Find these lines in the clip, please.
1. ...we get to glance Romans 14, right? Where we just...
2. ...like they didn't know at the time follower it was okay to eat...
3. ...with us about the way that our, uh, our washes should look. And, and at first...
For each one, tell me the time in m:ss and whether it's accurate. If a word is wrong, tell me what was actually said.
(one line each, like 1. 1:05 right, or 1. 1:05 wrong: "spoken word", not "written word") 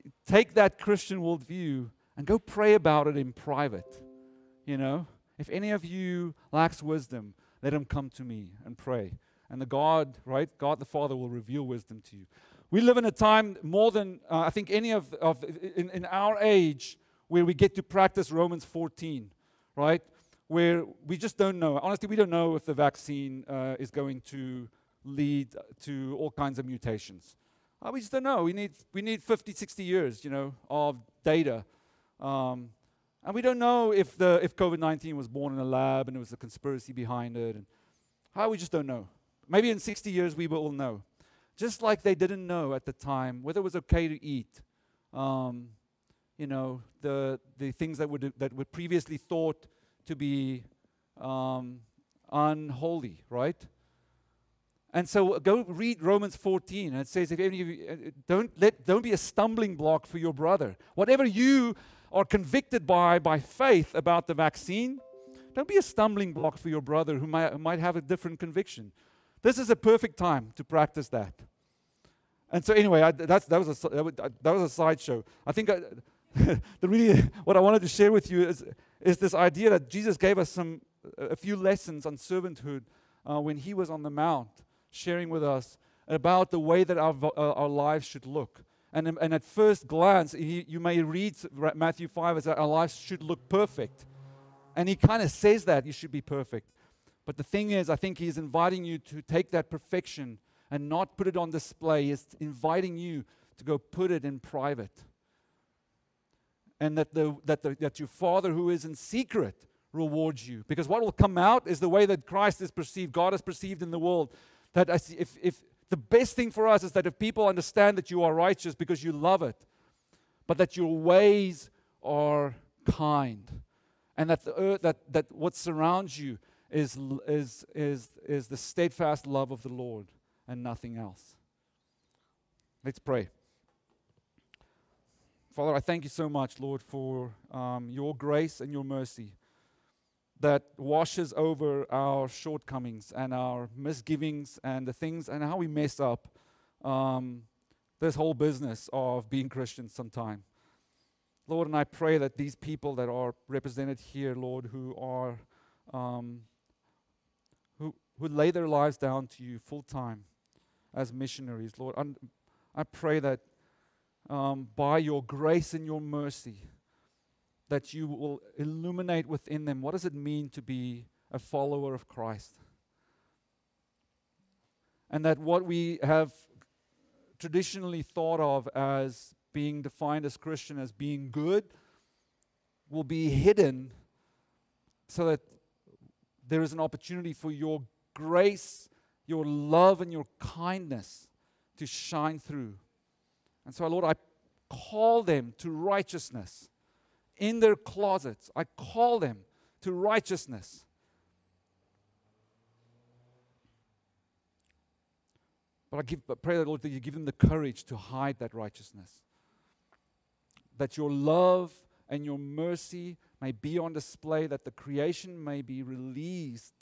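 1. 0:17 wrong: "practice", not "glance"
2. 0:41 wrong: "whether", not "follower"
3. 1:25 wrong: "lives", not "washes".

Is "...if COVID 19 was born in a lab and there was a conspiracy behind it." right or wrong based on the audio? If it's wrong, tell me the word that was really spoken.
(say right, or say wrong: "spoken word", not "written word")
right.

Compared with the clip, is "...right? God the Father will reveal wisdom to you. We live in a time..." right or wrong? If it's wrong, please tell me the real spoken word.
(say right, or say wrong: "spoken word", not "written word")
right.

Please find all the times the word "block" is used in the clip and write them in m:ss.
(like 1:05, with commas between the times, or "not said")
0:59, 1:06.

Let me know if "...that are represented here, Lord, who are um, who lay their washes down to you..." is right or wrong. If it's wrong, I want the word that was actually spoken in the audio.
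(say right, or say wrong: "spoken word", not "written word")
wrong: "lives", not "washes".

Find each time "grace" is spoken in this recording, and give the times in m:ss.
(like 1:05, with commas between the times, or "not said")
2:18, 2:45, 3:08.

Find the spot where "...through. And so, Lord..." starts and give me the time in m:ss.
3:12.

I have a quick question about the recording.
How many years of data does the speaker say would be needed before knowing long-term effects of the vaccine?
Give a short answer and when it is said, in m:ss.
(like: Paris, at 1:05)
50, 60 years, at 0:29.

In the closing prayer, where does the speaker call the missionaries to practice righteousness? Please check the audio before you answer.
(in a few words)
In their closets.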